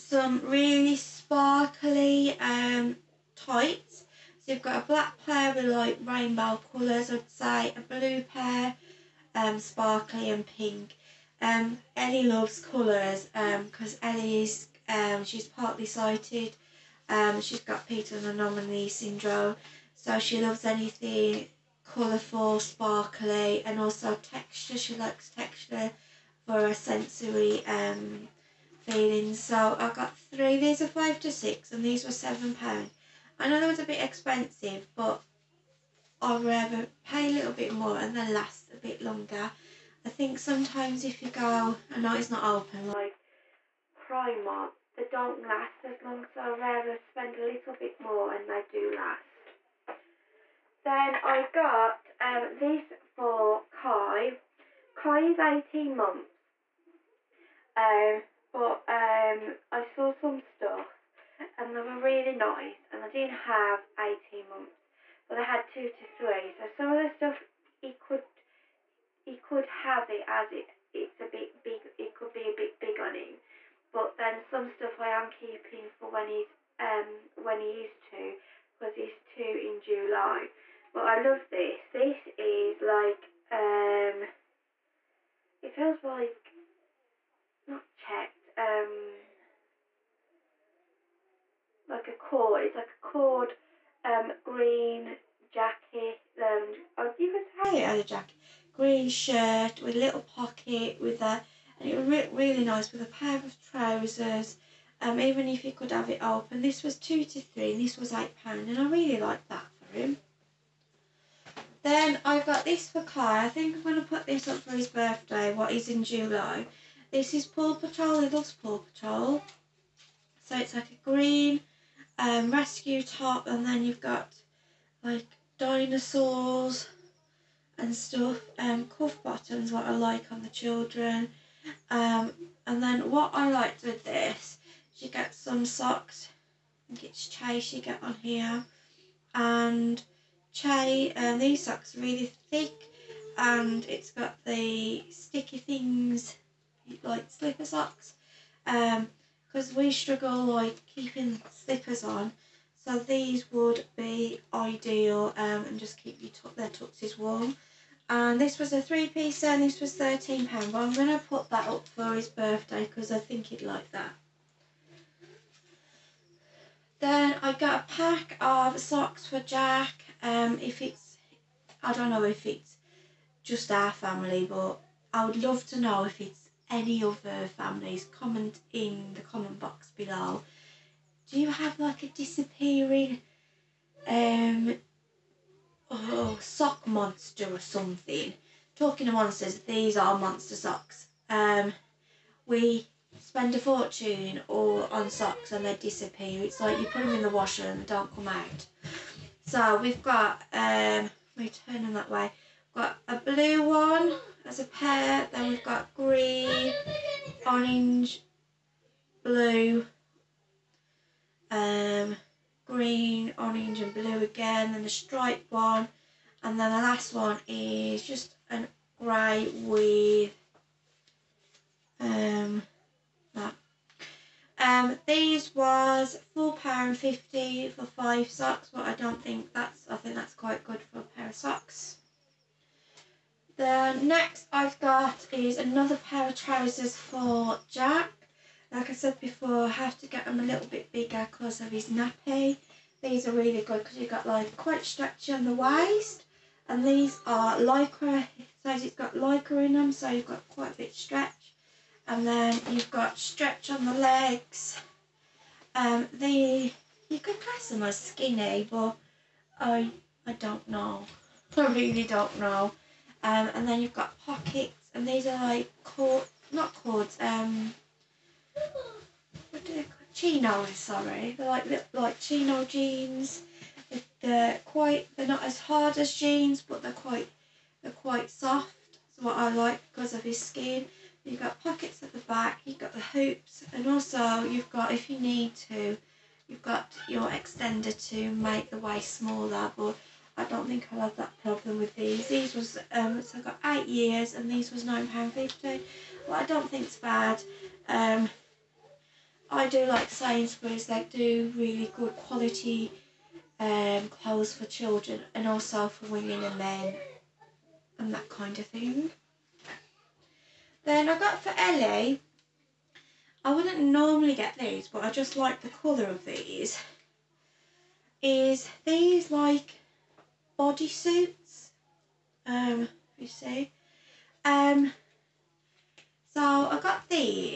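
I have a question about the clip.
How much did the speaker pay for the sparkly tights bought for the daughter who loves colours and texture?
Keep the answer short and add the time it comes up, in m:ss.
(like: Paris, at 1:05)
£7, at 0:32.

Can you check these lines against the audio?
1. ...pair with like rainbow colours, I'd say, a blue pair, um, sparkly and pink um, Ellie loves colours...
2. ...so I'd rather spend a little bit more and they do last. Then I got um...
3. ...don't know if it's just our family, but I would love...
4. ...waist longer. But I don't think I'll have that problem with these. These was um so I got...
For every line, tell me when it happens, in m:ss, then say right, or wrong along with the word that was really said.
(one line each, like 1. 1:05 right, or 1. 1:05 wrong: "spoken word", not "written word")
1. 0:05 right
2. 0:46 right
3. 2:51 right
4. 4:48 wrong: "smaller", not "longer".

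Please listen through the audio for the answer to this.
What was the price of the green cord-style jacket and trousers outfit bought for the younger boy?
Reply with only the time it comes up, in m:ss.
1:48.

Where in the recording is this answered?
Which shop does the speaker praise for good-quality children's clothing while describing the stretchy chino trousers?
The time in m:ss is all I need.
5:00.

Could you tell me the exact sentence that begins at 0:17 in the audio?
Um, she's got Peter's anomaly syndrome, so she loves anything colourful, sparkly, and also texture.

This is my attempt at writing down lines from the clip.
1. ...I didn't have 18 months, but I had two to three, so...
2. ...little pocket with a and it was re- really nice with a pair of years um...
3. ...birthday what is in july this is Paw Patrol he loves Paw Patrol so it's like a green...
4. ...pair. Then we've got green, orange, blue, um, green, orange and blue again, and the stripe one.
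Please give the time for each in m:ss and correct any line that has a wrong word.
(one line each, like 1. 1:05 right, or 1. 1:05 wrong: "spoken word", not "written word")
1. 1:03 right
2. 1:39 wrong: "trousers", not "years"
3. 1:54 right
4. 3:24 right.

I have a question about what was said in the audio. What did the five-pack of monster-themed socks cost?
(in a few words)
£4.50.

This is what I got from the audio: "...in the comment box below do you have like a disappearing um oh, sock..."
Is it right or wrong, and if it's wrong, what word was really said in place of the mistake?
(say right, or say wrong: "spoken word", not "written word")
right.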